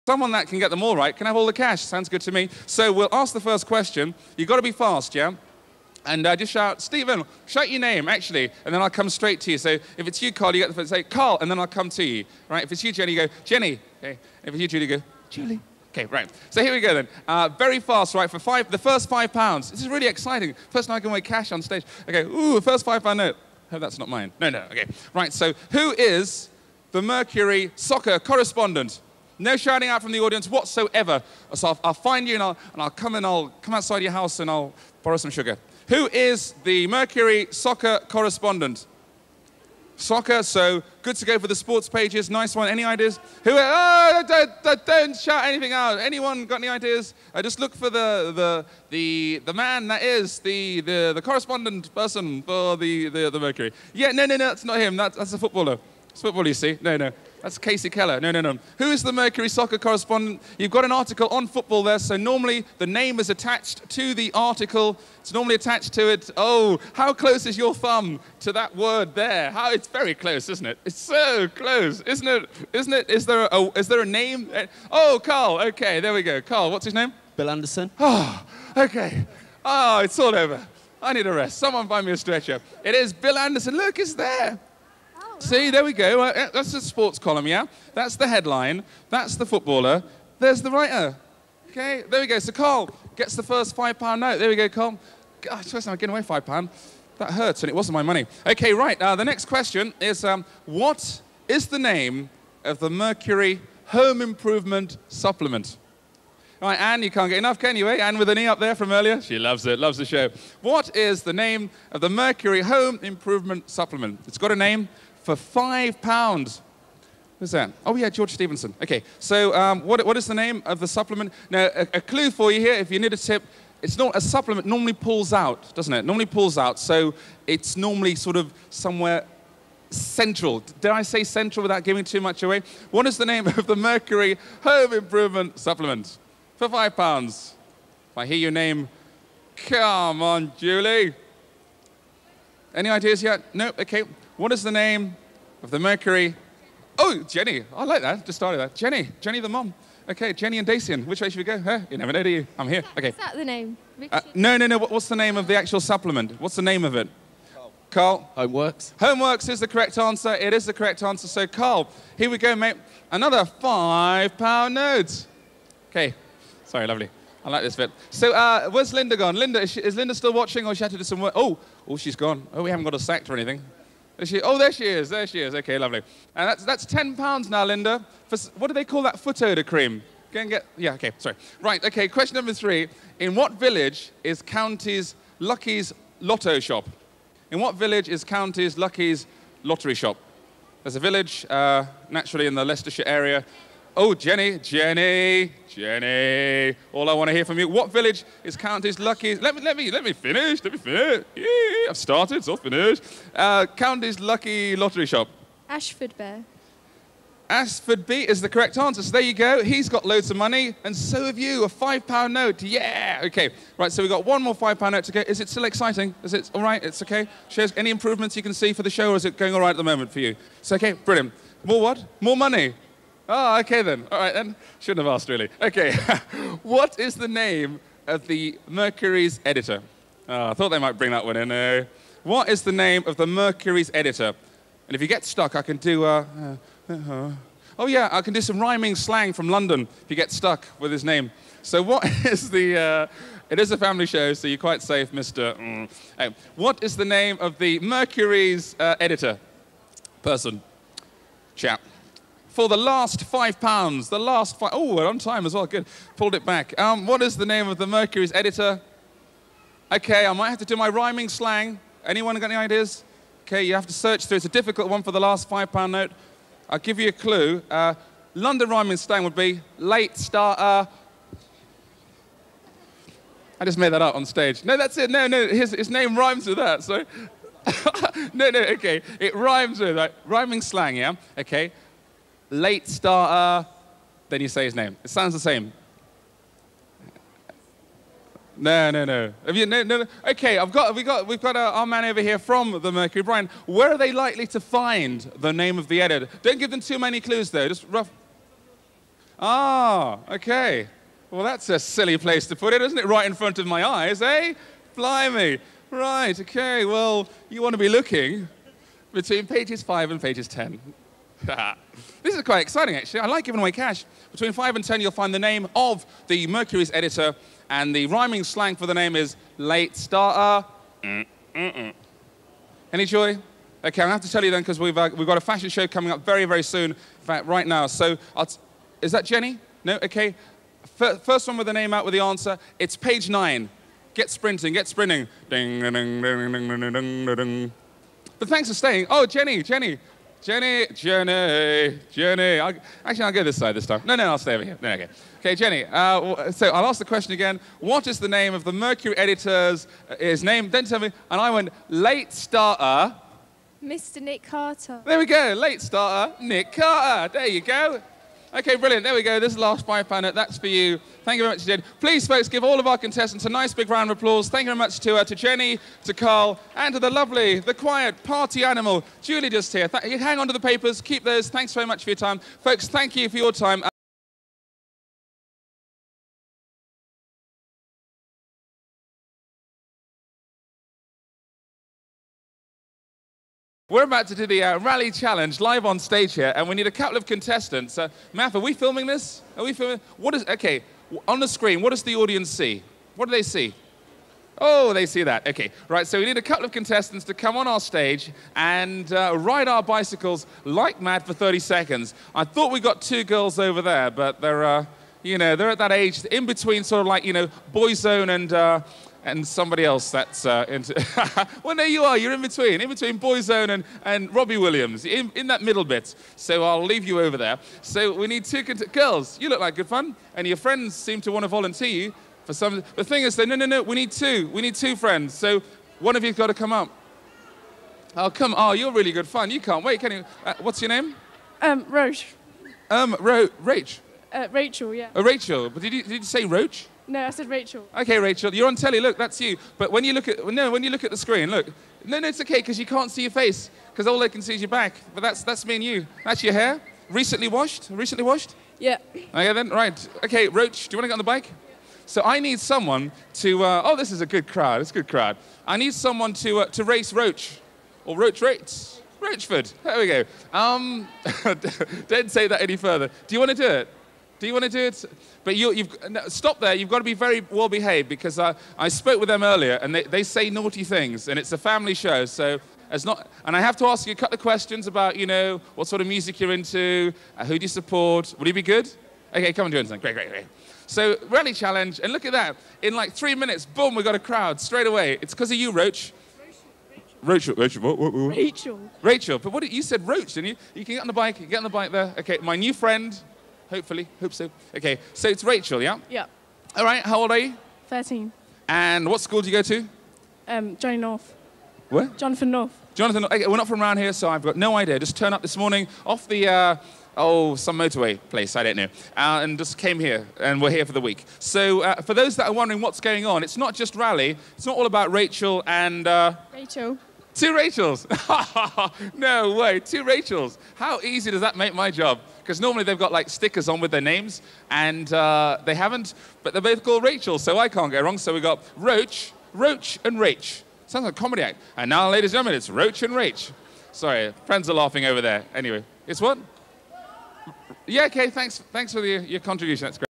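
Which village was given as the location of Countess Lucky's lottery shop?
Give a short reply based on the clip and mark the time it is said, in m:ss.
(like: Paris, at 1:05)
Asfordby, at 3:25.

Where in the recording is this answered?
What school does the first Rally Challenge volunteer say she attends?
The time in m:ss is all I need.
8:22.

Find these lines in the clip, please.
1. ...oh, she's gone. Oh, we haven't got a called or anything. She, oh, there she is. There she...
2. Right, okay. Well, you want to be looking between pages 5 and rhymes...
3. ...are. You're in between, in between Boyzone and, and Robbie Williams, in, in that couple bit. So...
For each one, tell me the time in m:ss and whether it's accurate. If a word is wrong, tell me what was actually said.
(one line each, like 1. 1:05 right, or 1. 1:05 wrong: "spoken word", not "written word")
1. 2:51 wrong: "sacked", not "called"
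2. 5:05 wrong: "pages", not "rhymes"
3. 6:52 wrong: "middle", not "couple".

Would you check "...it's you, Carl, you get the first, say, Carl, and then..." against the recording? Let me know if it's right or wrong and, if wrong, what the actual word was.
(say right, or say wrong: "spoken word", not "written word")
right.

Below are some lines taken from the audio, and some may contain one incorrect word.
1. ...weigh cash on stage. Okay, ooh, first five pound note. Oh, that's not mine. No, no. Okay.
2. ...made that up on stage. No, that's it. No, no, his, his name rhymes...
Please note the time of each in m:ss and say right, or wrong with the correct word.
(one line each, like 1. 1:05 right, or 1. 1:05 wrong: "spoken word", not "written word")
1. 0:21 right
2. 4:33 right.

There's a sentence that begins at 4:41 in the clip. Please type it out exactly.
Okay late starter, then you say his name.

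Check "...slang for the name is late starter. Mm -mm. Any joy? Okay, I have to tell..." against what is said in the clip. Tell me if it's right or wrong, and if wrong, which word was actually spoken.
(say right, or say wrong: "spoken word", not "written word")
right.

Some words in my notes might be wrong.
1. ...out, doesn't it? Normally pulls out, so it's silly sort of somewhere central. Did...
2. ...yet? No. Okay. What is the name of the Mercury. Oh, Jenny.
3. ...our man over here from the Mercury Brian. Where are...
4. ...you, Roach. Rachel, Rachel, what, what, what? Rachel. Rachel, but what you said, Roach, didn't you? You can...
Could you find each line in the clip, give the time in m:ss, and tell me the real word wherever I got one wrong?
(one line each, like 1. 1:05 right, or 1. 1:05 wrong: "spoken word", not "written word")
1. 2:05 wrong: "normally", not "silly"
2. 2:23 right
3. 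4:51 right
4. 8:05 right.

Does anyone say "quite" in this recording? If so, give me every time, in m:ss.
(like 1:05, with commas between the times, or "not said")
4:04, 5:12.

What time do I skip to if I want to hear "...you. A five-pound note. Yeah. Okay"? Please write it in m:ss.
3:31.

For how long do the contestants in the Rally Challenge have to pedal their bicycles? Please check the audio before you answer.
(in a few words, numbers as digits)
30 seconds.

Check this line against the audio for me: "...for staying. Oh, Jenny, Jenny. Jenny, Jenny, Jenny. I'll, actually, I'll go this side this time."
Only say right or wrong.
right.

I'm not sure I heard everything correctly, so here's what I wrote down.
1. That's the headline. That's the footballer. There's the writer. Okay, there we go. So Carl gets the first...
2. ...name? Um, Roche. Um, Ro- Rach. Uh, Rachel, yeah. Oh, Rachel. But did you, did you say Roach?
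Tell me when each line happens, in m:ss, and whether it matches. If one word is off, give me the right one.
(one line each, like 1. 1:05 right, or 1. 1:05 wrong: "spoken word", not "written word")
1. 1:27 right
2. 7:10 right.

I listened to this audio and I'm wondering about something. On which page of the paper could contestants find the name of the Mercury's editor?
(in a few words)
page 9.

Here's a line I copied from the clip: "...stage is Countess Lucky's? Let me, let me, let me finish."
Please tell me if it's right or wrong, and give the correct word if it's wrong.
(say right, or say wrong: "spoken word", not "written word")
wrong: "village", not "stage".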